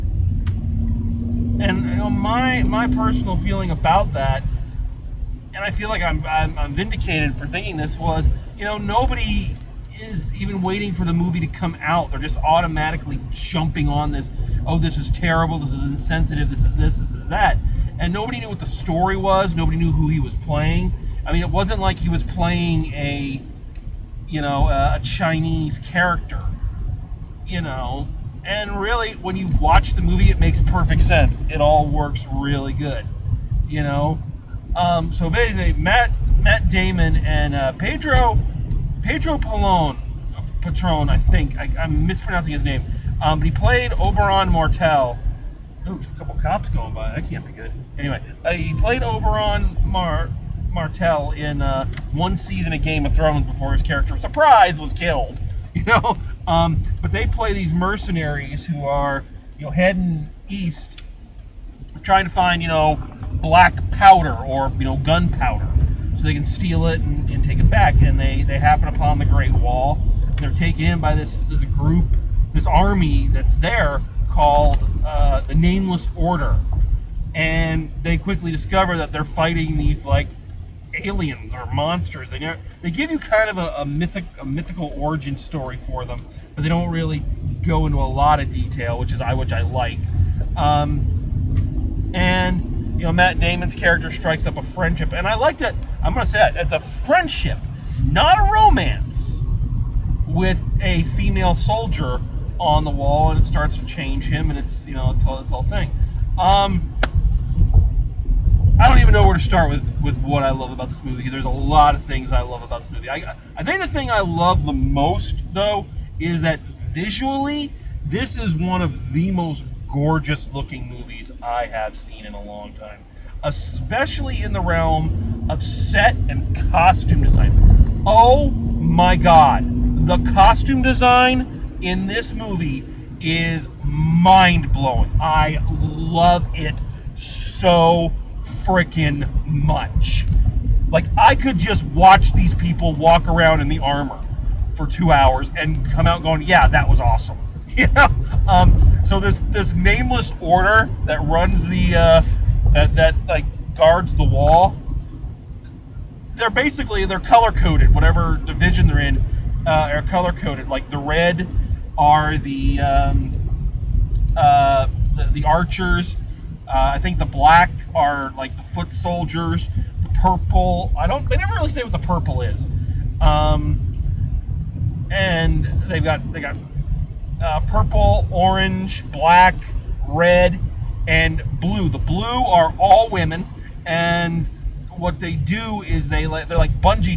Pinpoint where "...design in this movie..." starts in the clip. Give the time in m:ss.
2:10.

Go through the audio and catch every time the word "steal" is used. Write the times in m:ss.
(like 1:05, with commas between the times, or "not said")
1:06.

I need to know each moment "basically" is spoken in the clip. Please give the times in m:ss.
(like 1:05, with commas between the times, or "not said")
0:35, 2:36.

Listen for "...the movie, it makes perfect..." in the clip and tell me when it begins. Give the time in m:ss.
0:29.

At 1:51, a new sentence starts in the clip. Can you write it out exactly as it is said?
There's a lot of things I love about this movie.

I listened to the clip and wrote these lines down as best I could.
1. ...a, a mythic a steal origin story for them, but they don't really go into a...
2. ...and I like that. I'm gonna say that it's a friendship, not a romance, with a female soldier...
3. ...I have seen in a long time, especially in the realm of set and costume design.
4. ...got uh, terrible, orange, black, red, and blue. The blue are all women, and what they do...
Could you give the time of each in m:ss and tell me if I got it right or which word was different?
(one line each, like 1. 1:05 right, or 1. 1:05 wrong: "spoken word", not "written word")
1. 1:23 wrong: "mythical", not "steal"
2. 1:35 right
3. 2:01 right
4. 2:56 wrong: "purple", not "terrible".